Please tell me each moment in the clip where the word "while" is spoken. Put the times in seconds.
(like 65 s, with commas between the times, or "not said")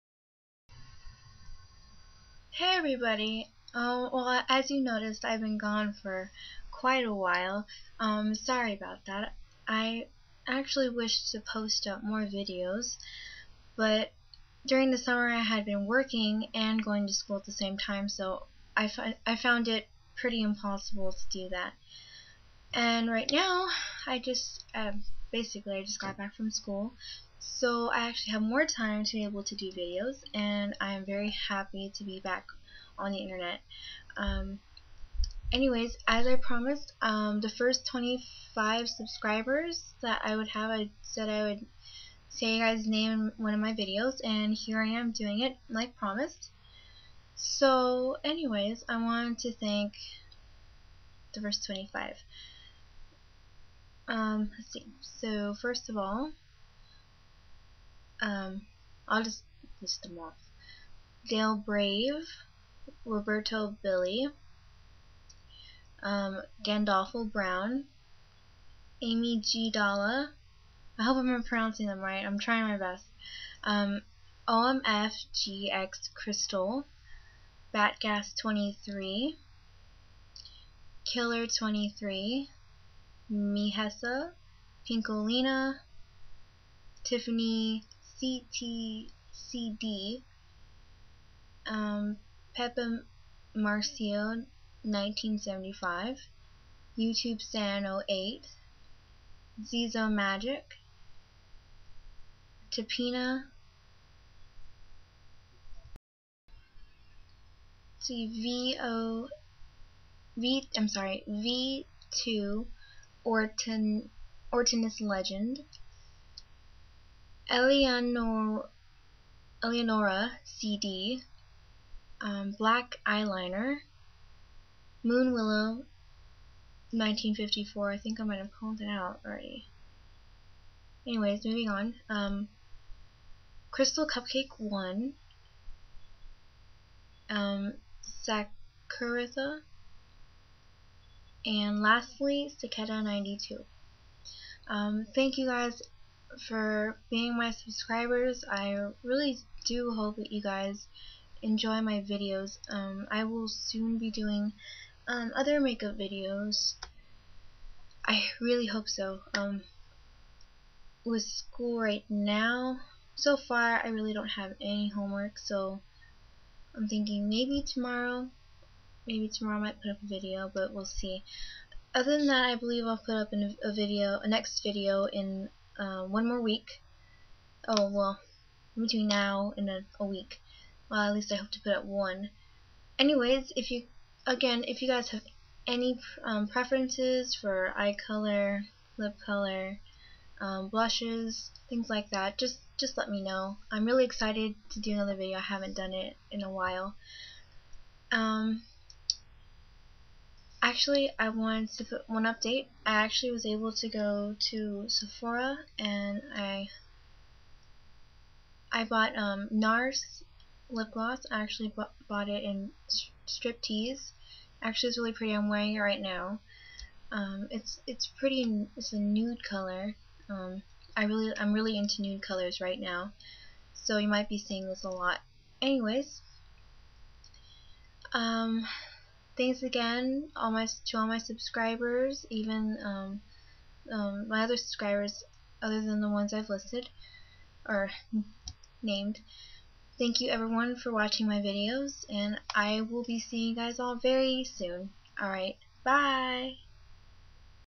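7 s, 196 s.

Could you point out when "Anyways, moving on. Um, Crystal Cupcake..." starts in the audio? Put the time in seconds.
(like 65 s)
131 s.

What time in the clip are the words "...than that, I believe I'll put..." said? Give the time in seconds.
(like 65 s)
172 s.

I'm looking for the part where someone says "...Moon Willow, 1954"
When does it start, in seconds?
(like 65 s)
125 s.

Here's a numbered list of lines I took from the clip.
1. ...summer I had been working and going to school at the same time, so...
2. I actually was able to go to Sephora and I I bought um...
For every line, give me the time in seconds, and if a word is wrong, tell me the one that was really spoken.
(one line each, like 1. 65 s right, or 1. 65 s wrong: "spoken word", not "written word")
1. 14 s right
2. 202 s right.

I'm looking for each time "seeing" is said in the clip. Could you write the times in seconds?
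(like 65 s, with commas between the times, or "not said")
224 s, 243 s.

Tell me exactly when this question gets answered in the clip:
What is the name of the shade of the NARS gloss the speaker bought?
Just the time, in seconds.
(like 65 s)
213 s.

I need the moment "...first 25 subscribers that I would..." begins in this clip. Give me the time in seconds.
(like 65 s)
37 s.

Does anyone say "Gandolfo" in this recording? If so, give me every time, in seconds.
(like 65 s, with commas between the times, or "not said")
66 s.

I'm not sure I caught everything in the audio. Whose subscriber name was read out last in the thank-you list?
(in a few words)
Cicada 92.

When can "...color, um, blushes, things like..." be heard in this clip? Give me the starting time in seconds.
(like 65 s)
189 s.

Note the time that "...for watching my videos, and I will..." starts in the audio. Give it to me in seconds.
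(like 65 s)
240 s.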